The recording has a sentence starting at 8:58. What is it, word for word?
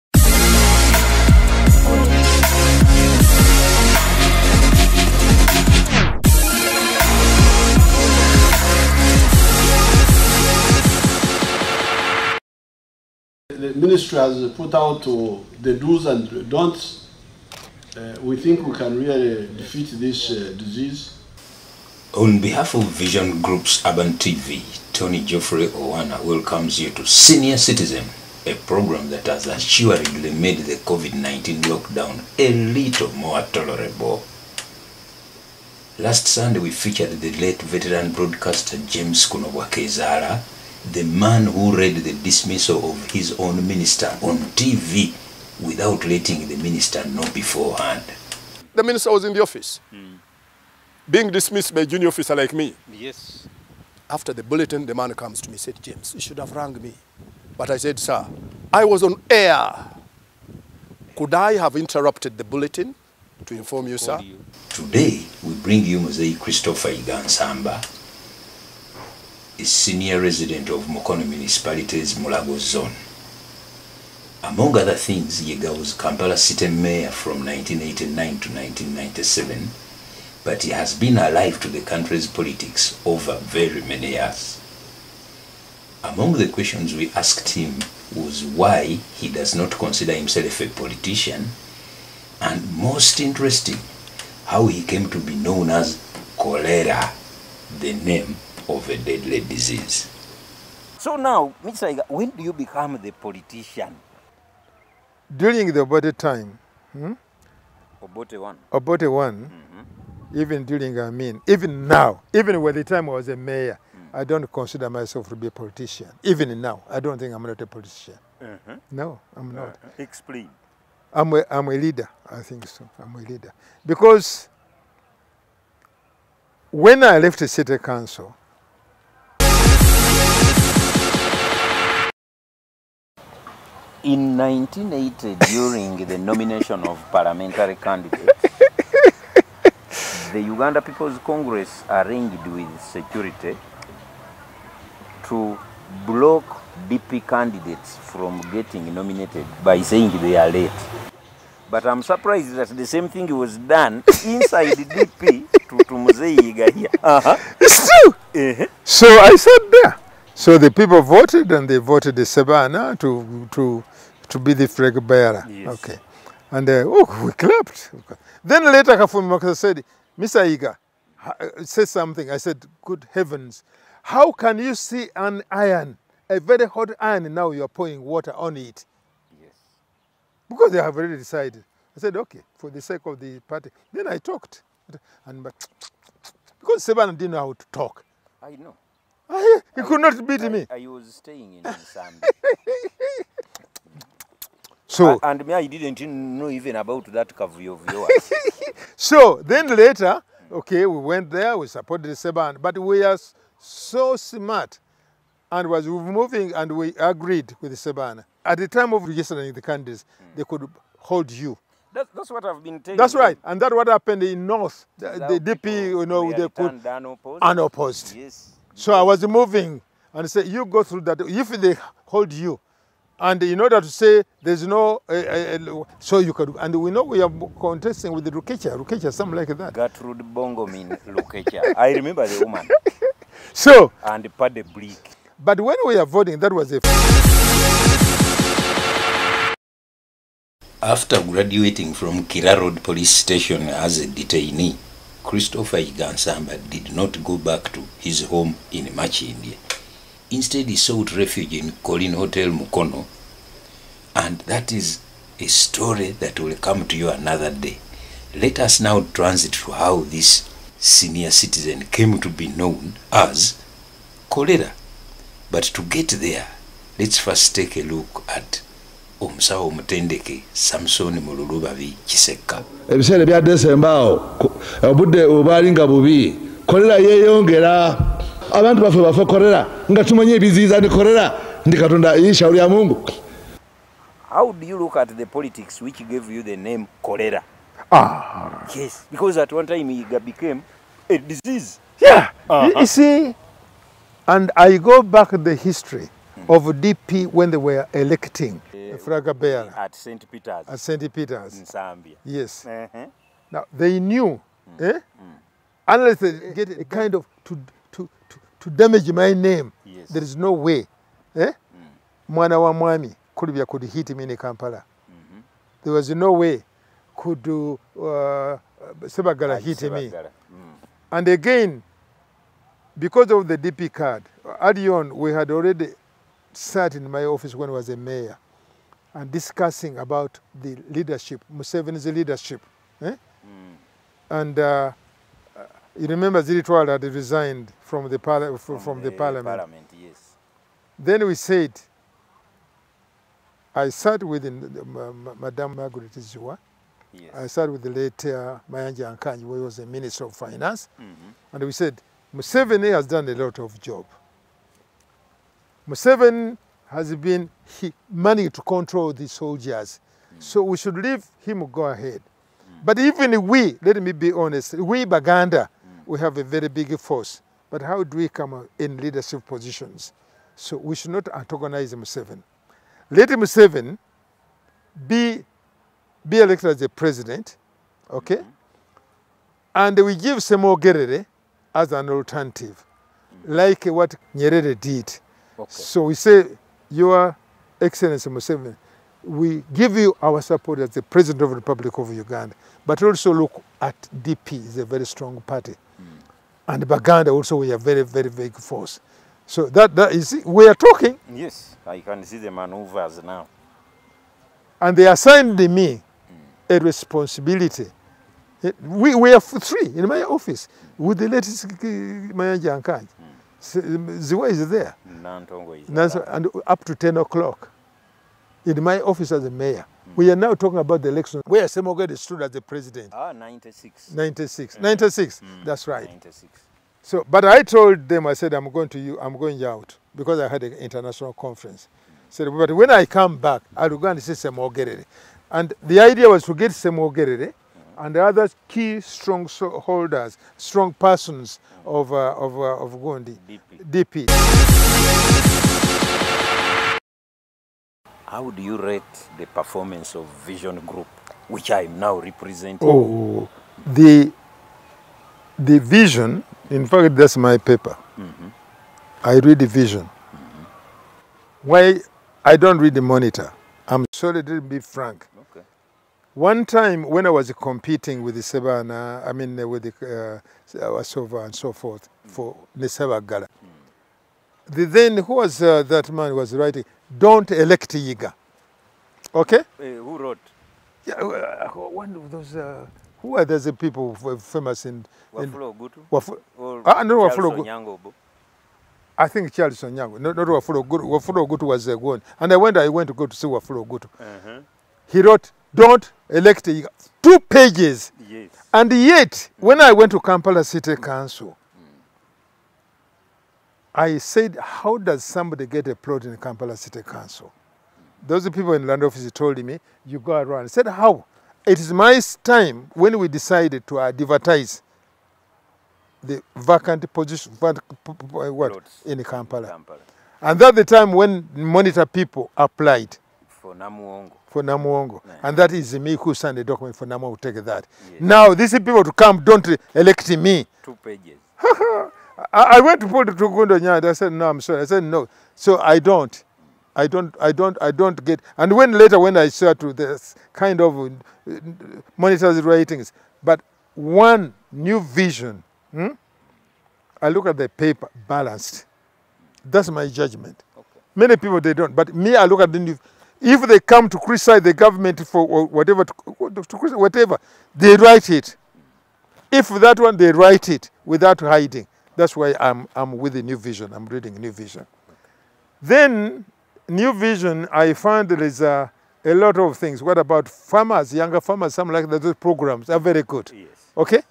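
And when later, when I start to this kind of uh, the ratings, but one new vision, hmm?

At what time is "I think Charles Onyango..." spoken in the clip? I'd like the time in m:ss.
8:09.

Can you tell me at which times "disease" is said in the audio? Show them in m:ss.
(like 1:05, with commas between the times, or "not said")
0:20, 1:39, 4:51.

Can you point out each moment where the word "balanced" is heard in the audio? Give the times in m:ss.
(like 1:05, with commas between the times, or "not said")
9:08.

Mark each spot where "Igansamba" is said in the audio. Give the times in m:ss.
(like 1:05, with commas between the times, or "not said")
1:06, 4:05.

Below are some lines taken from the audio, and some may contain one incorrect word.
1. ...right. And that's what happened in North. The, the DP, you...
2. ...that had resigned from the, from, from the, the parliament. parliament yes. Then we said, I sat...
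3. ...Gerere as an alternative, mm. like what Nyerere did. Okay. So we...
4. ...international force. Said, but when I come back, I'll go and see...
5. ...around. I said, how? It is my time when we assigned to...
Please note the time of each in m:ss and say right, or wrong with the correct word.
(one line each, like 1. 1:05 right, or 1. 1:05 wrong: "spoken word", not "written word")
1. 3:33 right
2. 5:36 right
3. 6:20 right
4. 7:10 wrong: "conference", not "force"
5. 8:30 wrong: "decided", not "assigned".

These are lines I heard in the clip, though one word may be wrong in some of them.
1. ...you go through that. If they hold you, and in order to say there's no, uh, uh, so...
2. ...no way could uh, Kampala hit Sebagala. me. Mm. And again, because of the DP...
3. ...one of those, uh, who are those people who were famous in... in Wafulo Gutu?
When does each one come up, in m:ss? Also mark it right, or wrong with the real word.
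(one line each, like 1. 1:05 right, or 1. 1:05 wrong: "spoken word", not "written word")
1. 3:40 right
2. 5:16 wrong: "Sebagala", not "Kampala"
3. 8:01 right.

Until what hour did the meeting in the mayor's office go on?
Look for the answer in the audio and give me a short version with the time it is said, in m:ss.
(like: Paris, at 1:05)
10 o'clock, at 6:56.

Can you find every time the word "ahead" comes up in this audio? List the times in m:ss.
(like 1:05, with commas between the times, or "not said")
6:01.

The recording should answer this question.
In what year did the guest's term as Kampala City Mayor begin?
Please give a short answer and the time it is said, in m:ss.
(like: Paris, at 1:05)
1989, at 1:17.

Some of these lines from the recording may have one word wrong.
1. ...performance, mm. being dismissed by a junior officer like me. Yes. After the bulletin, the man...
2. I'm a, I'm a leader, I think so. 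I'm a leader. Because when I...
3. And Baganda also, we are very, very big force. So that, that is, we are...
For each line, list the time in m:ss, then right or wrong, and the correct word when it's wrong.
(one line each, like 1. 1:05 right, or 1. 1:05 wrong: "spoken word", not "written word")
1. 0:49 wrong: "office", not "performance"
2. 2:01 right
3. 6:36 right.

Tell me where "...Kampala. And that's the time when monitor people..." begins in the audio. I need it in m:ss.
8:39.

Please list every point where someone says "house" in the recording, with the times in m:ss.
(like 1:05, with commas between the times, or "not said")
not said.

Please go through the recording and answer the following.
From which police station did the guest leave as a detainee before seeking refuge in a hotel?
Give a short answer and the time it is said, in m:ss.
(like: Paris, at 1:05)
Kira Road, at 4:02.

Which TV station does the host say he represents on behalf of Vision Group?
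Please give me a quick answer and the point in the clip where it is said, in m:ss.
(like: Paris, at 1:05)
Urban TV, at 0:23.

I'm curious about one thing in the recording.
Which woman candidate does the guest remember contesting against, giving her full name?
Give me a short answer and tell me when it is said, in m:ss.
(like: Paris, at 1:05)
Gertrude Bongomin Rukecha, at 3:49.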